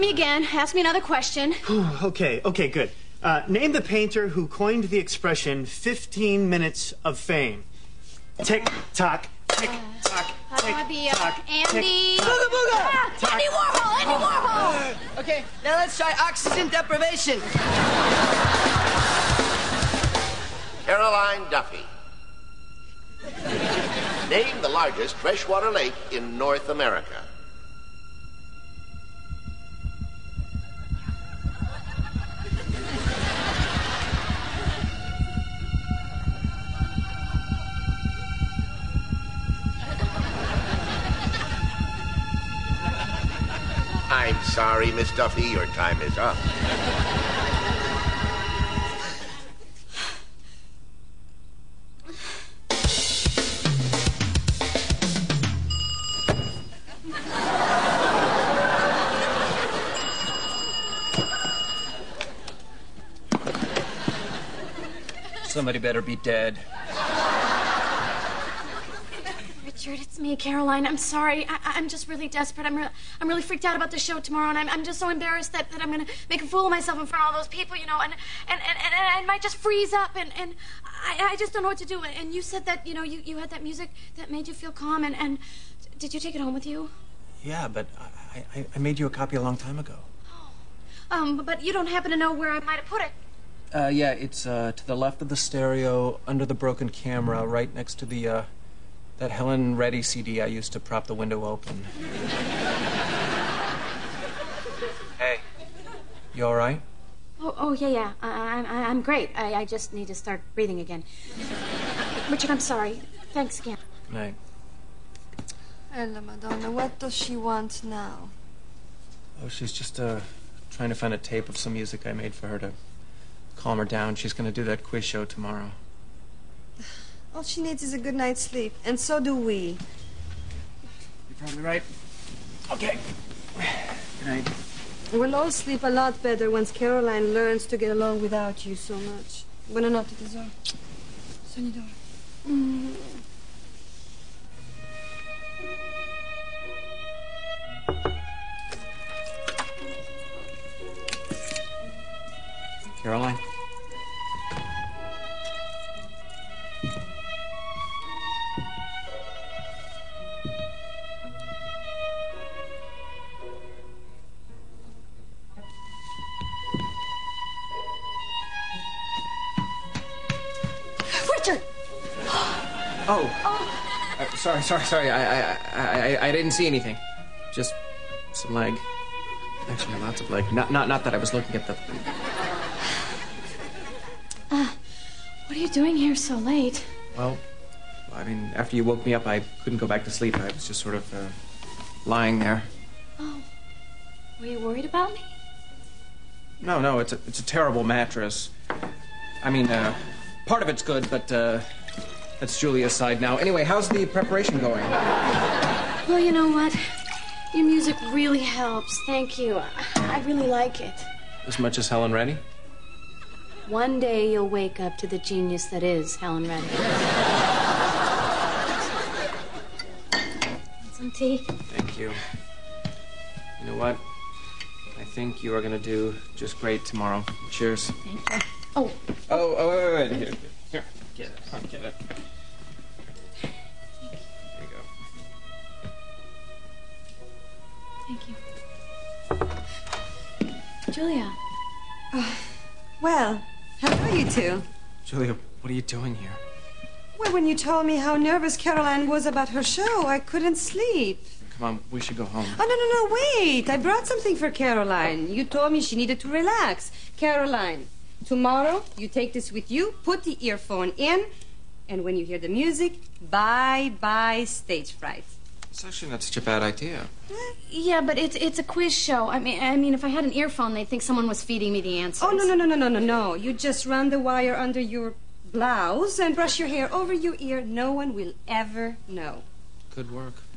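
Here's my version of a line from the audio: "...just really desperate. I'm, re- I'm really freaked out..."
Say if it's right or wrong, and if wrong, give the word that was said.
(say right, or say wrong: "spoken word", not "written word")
right.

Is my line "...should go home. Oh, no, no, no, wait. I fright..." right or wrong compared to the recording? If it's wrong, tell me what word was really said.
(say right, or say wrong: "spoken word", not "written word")
wrong: "brought", not "fright".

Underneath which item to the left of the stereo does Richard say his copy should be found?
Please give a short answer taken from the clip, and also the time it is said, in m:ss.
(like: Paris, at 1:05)
the broken camera, at 1:36.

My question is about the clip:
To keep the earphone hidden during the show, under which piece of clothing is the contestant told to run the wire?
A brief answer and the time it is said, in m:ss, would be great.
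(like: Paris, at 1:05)
blouse, at 4:35.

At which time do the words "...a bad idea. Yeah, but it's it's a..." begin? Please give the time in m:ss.
4:26.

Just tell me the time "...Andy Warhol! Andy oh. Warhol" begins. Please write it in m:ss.
0:13.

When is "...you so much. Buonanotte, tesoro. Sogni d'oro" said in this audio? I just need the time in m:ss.
2:18.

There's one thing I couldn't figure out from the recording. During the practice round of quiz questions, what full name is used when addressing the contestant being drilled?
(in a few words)
Caroline Duffy.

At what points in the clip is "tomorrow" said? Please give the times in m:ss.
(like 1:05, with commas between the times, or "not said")
1:14, 2:05, 3:46, 4:18.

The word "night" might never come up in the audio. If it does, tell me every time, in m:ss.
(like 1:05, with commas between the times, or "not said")
1:54, 2:08, 2:14.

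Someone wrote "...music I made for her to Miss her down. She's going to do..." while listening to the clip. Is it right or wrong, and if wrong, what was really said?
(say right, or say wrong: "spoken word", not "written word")
wrong: "Calm", not "Miss".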